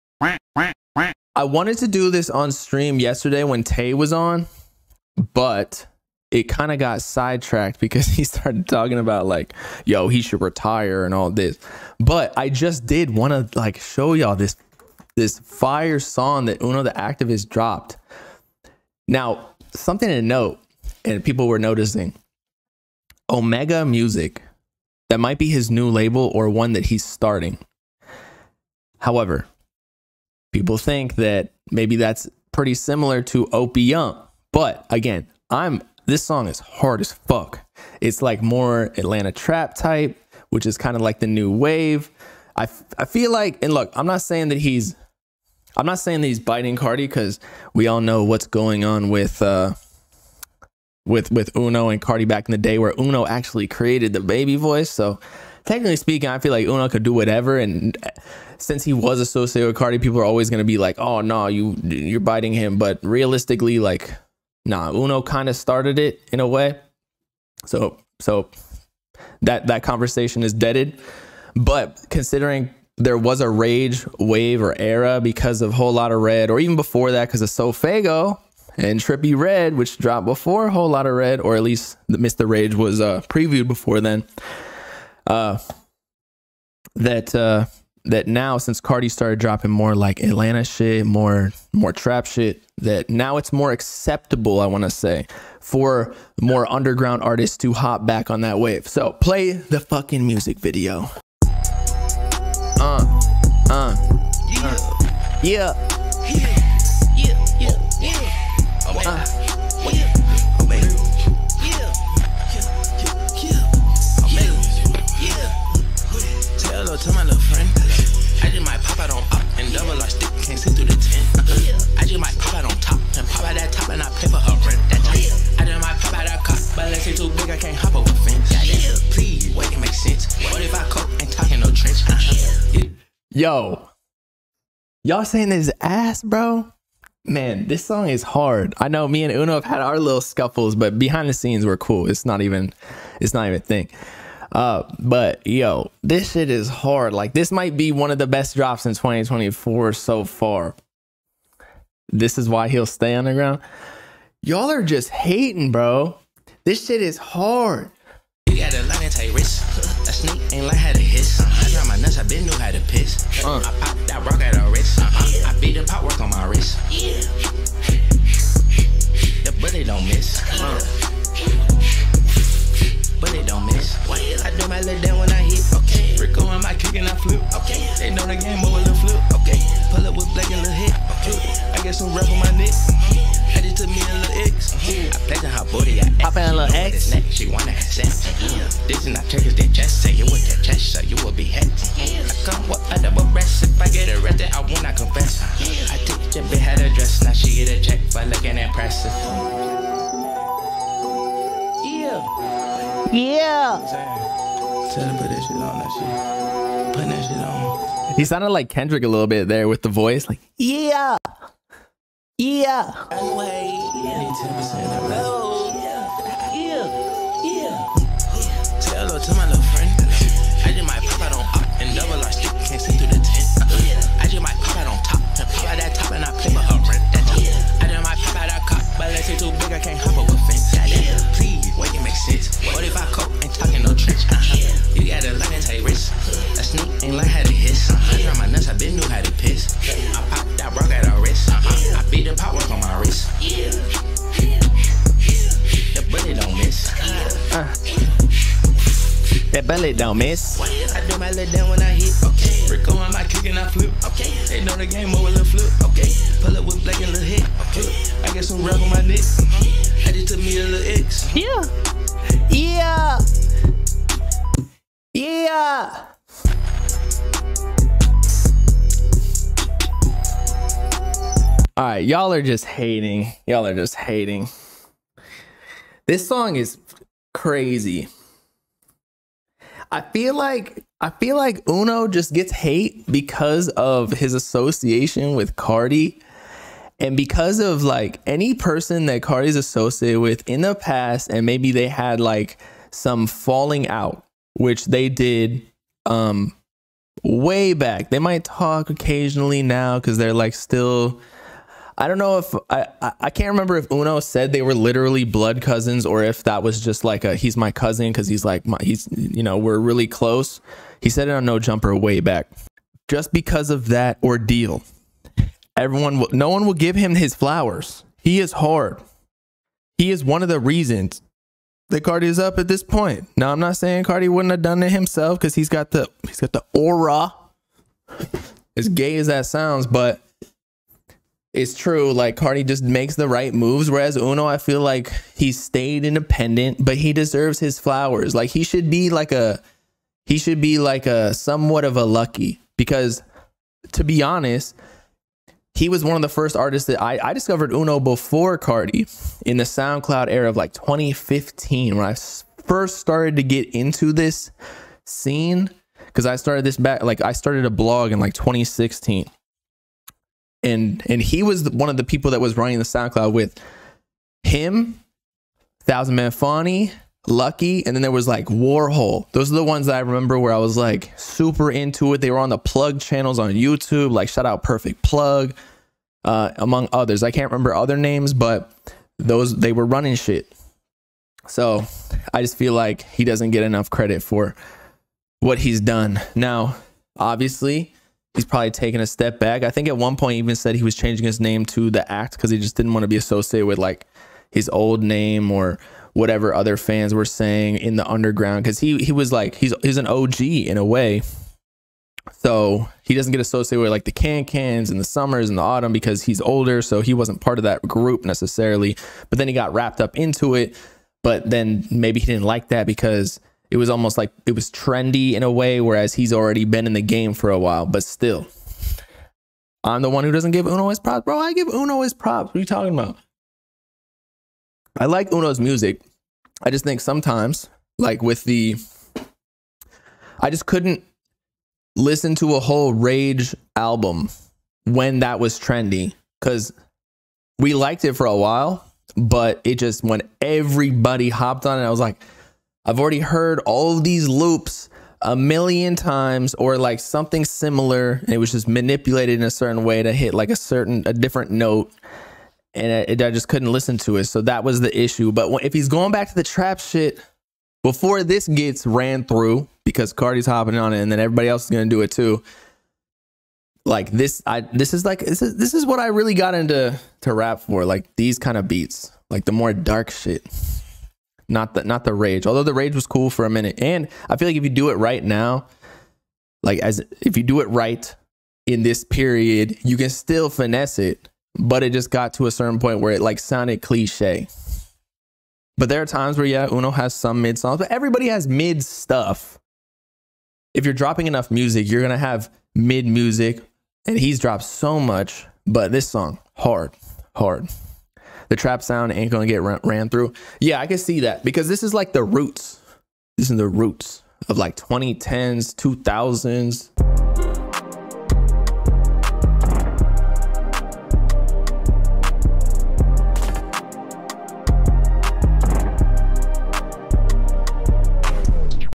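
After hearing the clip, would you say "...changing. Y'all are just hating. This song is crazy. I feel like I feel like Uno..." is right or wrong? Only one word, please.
wrong.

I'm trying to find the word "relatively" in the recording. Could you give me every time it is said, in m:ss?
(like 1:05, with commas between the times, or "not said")
not said.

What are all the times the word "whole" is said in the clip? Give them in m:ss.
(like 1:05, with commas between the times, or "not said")
1:15, 1:20, 7:12.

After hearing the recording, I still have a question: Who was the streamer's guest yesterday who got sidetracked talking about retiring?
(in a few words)
Tay.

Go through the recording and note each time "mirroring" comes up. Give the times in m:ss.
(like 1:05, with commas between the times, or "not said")
not said.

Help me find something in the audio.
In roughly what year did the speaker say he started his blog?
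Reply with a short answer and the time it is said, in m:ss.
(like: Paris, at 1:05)
2016, at 5:58.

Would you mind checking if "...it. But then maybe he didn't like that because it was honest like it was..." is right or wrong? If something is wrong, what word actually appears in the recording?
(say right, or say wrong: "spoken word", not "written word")
wrong: "almost", not "honest".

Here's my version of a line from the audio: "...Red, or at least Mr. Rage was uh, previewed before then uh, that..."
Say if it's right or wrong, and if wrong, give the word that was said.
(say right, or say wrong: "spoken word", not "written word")
right.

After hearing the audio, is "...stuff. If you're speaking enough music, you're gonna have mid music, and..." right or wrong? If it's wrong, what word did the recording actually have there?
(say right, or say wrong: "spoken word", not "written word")
wrong: "dropping", not "speaking".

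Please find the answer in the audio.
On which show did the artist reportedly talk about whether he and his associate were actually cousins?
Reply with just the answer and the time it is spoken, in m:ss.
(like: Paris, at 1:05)
No Jumper, at 5:11.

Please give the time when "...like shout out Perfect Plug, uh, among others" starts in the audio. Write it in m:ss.
6:14.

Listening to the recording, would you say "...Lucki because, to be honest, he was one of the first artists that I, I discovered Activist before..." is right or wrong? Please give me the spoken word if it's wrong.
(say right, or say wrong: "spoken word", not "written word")
wrong: "Uno", not "Activist".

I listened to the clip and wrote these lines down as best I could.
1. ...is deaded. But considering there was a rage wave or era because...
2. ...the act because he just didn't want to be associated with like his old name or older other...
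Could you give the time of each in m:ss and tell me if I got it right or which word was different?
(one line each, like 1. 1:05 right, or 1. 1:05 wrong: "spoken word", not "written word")
1. 1:10 right
2. 6:31 wrong: "whatever", not "older".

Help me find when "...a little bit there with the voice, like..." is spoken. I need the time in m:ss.
3:29.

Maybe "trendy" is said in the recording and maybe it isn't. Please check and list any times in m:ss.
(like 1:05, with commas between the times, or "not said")
6:54, 7:15.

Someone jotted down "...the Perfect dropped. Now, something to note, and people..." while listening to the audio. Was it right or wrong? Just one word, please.
wrong.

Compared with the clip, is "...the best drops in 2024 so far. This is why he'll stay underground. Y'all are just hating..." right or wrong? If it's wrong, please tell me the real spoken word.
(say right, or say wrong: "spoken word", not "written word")
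right.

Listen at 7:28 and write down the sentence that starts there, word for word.
And it was just manipulated in a certain way to hit like a certain, a different note.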